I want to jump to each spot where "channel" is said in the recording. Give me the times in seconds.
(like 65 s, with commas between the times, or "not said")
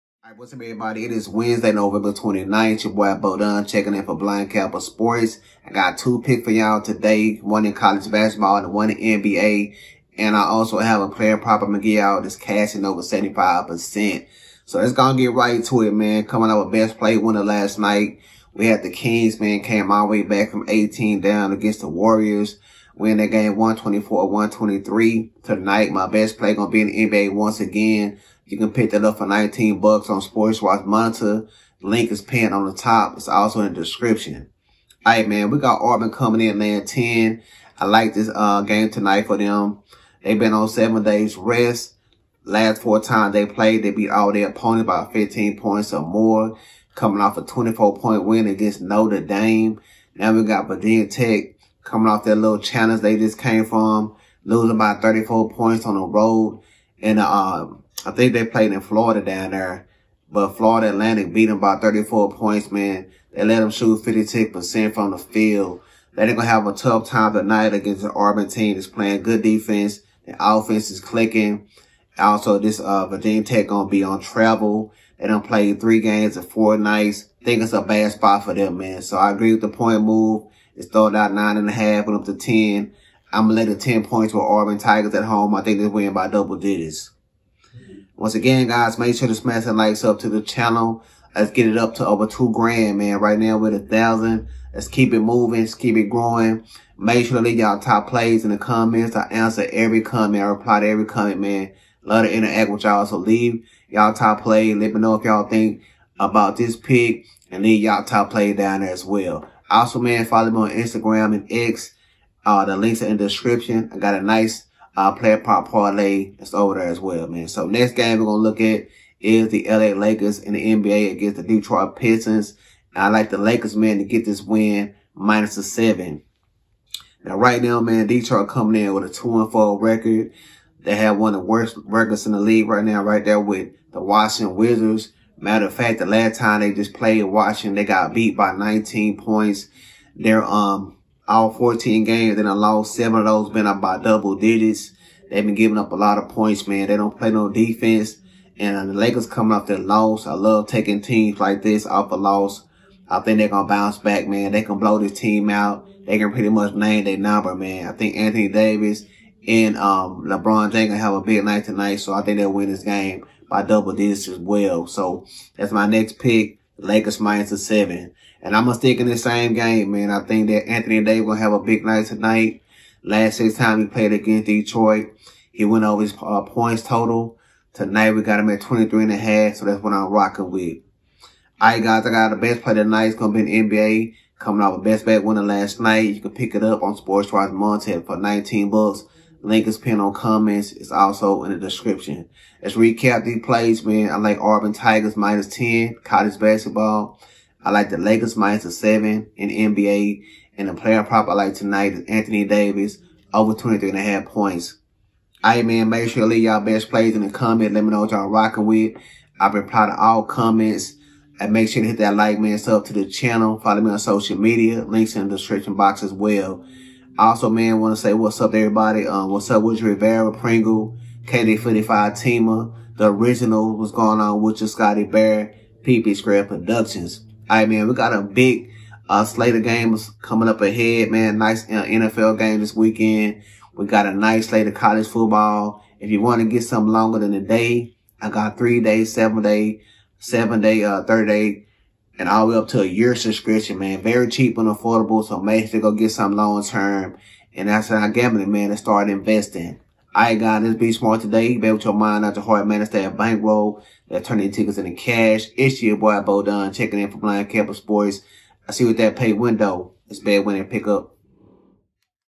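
90 s, 213 s.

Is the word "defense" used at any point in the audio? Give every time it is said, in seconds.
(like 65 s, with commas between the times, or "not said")
69 s, 147 s.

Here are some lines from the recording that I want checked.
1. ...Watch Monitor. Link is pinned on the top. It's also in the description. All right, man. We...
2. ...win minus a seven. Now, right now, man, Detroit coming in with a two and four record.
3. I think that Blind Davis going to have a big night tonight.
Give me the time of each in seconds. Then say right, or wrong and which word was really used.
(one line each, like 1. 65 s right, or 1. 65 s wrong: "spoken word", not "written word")
1. 30 s right
2. 124 s right
3. 170 s wrong: "Anthony", not "Blind".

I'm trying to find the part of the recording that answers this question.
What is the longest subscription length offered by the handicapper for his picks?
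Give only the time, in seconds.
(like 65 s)
242 s.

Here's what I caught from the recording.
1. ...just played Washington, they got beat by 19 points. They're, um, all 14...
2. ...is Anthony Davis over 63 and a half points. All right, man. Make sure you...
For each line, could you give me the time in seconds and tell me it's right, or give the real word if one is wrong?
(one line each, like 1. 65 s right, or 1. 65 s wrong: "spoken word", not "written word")
1. 136 s right
2. 201 s wrong: "23", not "63".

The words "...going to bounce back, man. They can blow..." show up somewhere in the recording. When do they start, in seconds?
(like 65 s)
153 s.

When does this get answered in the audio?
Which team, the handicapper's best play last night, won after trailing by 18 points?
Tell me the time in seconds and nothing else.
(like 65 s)
18 s.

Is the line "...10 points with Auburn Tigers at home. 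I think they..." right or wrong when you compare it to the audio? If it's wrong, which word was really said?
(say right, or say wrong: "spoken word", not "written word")
right.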